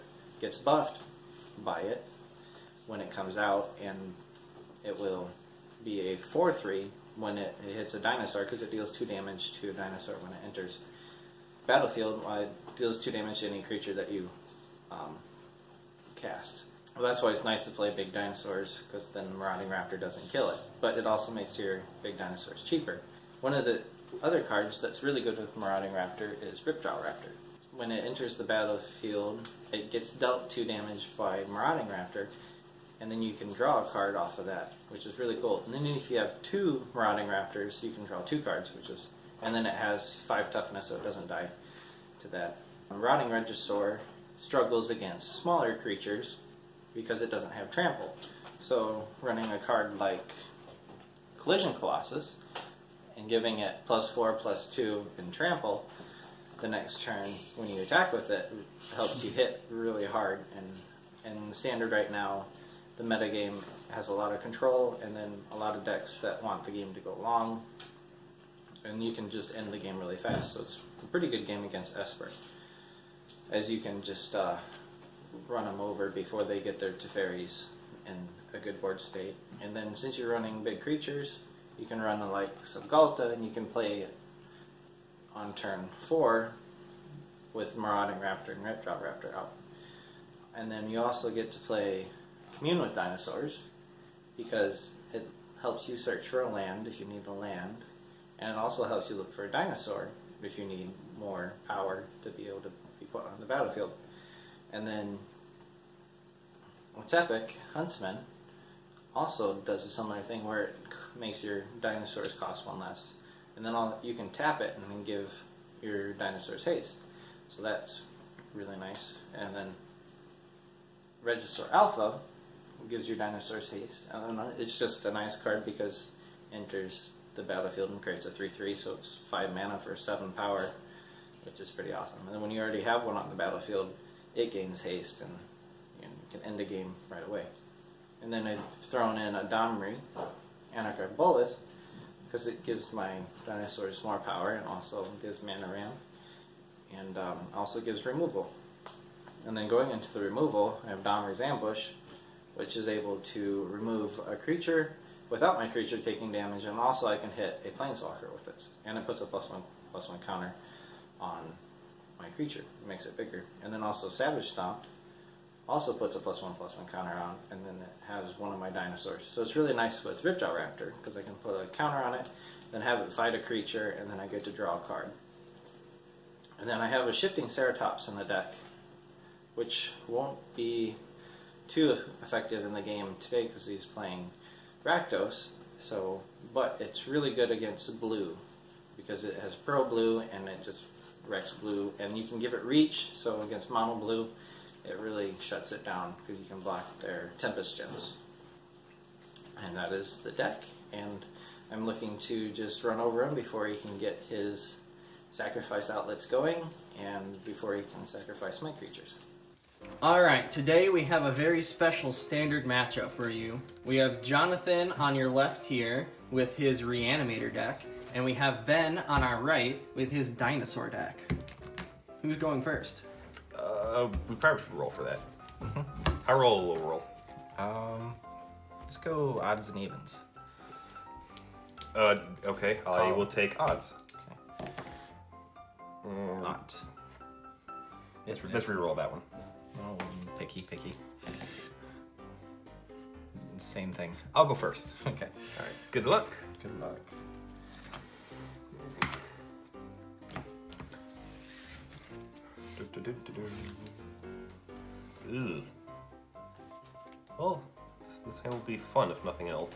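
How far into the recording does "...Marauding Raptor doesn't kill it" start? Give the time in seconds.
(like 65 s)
19 s.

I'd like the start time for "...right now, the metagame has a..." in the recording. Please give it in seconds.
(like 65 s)
61 s.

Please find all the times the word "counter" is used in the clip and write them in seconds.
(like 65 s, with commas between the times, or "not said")
160 s, 166 s, 171 s.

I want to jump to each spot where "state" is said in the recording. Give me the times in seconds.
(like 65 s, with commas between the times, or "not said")
78 s.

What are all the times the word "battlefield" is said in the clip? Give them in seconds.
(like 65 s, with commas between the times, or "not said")
11 s, 28 s, 103 s, 127 s, 133 s.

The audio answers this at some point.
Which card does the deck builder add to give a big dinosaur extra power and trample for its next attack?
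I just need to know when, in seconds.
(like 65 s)
51 s.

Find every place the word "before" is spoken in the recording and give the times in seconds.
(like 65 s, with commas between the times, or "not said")
76 s, 203 s, 207 s.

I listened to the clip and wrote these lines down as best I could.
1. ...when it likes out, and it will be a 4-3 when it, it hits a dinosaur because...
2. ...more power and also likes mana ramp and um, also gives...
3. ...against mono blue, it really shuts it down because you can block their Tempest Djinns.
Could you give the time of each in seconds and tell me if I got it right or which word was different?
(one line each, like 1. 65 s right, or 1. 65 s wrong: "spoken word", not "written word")
1. 2 s wrong: "comes", not "likes"
2. 144 s wrong: "gives", not "likes"
3. 193 s right.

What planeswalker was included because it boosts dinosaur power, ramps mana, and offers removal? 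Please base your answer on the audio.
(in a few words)
Domri, Anarch of Bolas.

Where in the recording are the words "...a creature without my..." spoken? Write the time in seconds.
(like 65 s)
154 s.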